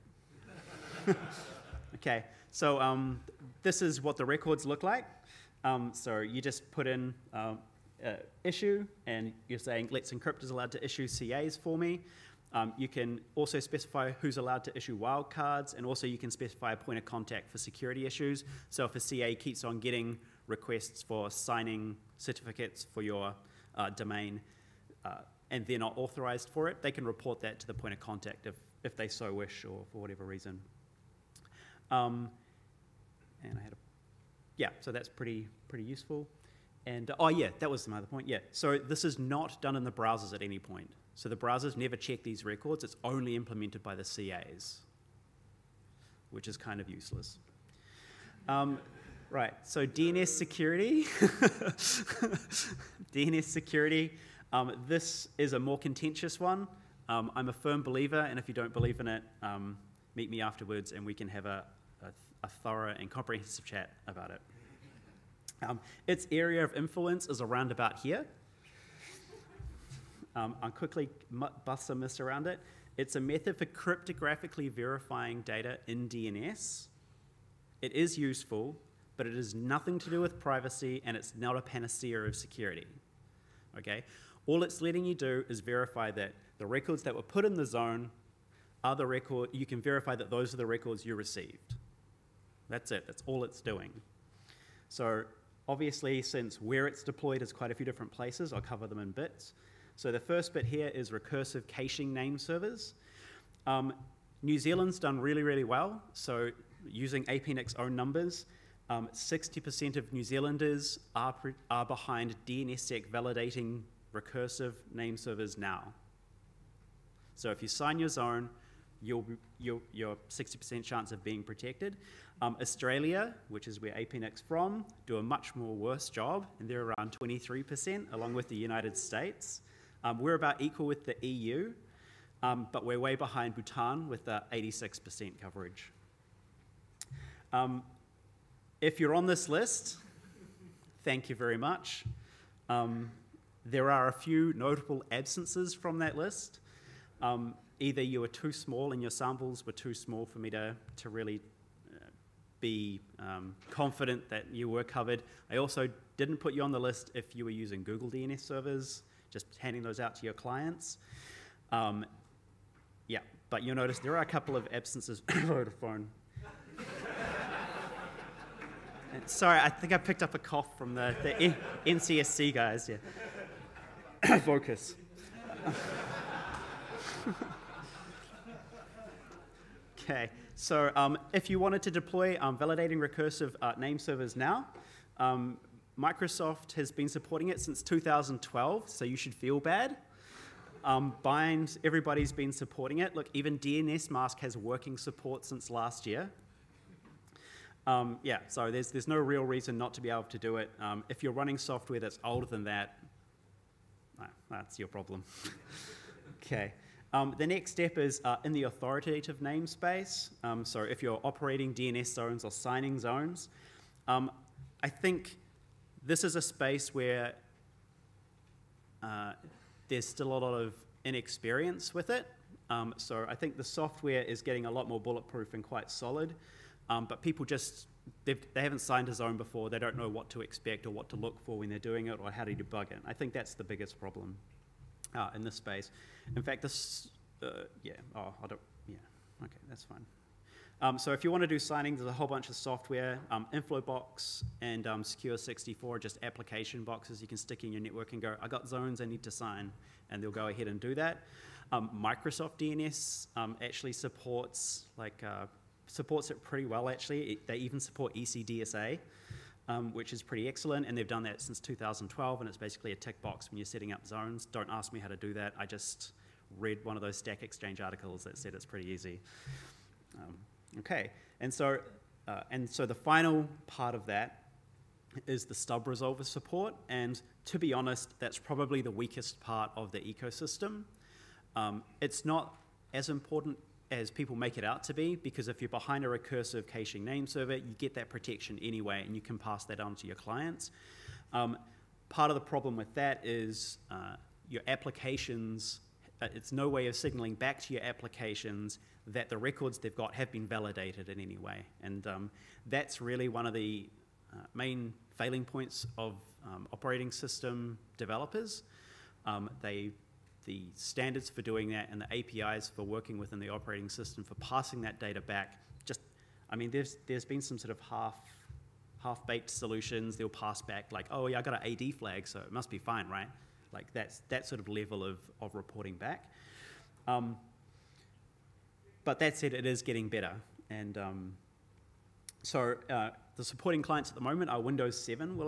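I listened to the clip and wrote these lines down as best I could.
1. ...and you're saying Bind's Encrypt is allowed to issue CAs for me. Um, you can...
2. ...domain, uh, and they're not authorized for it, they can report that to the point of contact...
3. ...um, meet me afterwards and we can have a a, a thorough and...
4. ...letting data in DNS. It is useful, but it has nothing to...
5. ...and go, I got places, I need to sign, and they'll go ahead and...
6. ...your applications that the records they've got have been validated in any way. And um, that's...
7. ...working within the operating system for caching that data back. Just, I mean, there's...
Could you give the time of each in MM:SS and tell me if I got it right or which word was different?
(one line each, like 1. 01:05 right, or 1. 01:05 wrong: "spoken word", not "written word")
1. 00:09 wrong: "Let", not "Bind"
2. 00:23 right
3. 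00:59 right
4. 01:14 wrong: "verifying", not "letting"
5. 04:08 wrong: "zones", not "places"
6. 04:57 right
7. 05:12 wrong: "passing", not "caching".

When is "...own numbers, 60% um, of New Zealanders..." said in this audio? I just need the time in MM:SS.
01:47.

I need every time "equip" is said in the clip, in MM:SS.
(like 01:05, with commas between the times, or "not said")
not said.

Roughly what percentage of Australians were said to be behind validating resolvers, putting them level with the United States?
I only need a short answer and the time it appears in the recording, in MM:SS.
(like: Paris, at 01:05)
23%, at 02:07.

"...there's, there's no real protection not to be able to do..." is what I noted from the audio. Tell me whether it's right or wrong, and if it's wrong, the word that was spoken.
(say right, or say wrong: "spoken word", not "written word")
wrong: "reason", not "protection".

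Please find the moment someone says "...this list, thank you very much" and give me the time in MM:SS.
02:19.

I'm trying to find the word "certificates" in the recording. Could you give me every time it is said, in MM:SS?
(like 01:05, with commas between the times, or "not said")
00:22.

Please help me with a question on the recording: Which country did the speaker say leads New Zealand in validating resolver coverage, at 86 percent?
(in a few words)
Bhutan.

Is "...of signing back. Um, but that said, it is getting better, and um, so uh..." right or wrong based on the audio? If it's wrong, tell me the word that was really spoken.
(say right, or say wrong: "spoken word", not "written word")
wrong: "reporting", not "signing".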